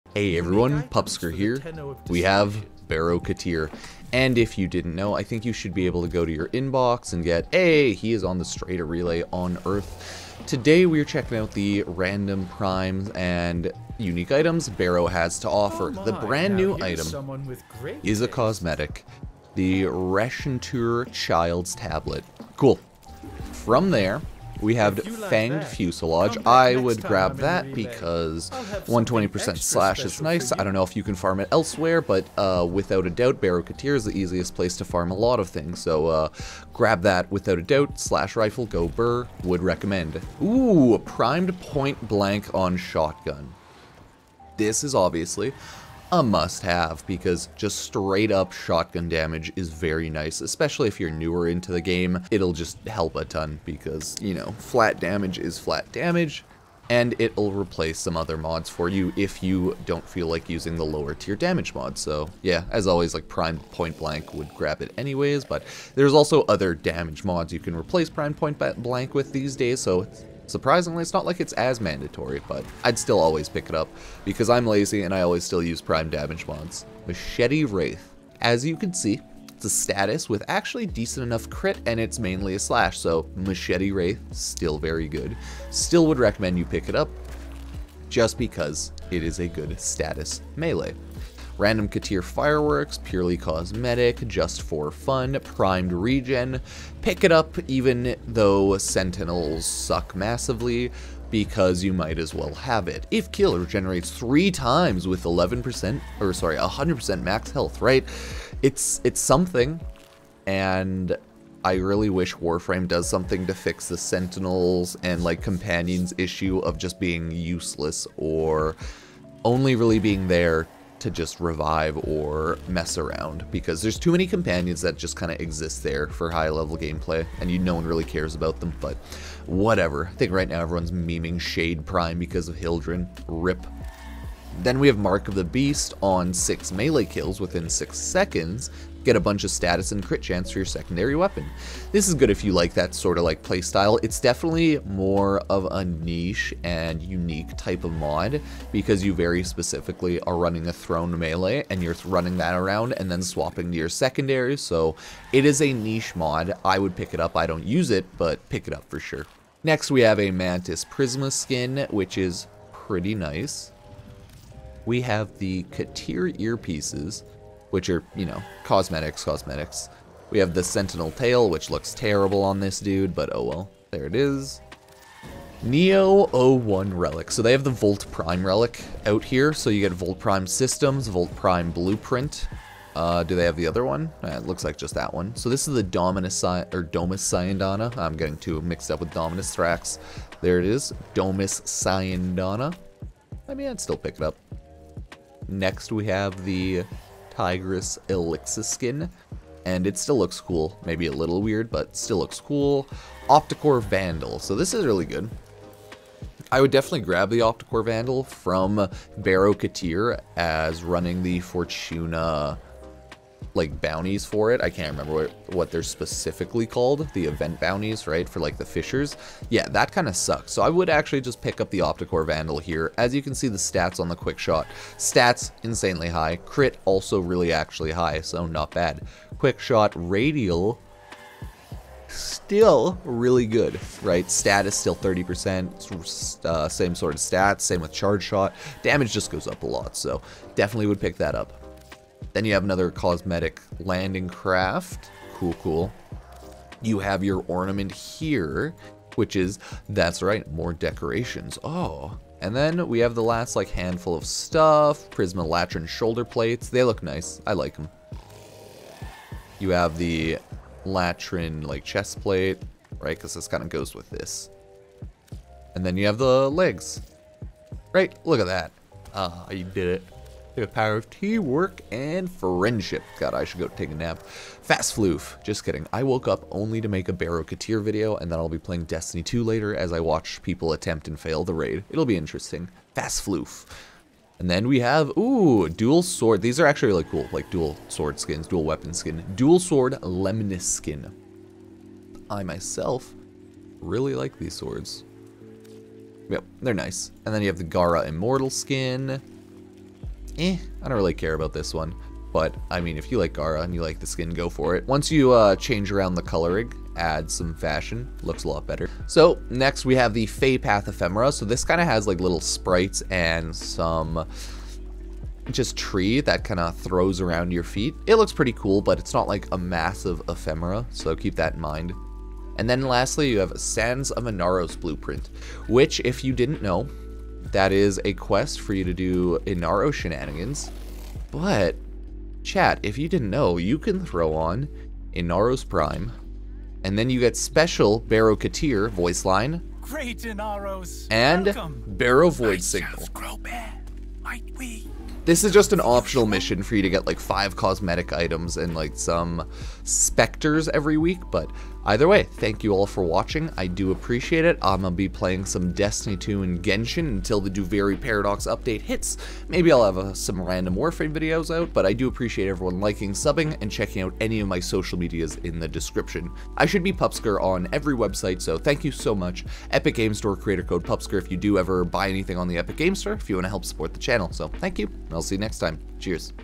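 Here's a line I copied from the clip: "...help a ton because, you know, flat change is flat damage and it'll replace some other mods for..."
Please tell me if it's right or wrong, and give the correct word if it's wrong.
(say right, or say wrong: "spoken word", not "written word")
wrong: "damage", not "change".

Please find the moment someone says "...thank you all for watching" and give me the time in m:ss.
5:52.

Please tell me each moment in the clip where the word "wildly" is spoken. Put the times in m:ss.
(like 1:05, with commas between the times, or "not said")
not said.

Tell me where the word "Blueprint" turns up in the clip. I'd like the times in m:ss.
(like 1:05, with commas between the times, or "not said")
3:01, 5:24.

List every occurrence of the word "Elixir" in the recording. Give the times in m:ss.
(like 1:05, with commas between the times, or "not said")
3:18.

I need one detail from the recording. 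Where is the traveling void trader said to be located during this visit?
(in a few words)
Strata Relay on Earth.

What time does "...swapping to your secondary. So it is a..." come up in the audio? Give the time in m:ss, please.
2:33.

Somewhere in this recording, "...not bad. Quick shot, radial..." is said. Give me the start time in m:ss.
3:48.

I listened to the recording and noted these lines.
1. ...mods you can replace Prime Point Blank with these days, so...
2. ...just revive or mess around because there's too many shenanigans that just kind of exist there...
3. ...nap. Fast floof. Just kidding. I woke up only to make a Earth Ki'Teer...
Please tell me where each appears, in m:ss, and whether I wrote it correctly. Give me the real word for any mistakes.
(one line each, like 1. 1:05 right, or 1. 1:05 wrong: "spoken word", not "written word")
1. 1:07 right
2. 2:01 wrong: "companions", not "shenanigans"
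3. 4:33 wrong: "Baro", not "Earth".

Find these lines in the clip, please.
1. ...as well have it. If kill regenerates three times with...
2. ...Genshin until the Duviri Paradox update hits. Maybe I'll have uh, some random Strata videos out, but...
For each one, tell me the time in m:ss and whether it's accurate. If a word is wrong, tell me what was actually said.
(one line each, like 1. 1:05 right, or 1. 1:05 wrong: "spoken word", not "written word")
1. 1:42 right
2. 5:56 wrong: "Warframe", not "Strata".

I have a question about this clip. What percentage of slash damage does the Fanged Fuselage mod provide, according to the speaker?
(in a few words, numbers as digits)
120%.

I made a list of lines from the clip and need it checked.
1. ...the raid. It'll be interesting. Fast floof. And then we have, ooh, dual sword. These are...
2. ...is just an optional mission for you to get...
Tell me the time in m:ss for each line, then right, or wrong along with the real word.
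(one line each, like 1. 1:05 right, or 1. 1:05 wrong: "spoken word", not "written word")
1. 4:41 right
2. 5:45 right.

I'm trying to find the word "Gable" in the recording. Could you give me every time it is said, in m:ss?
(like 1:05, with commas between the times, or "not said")
not said.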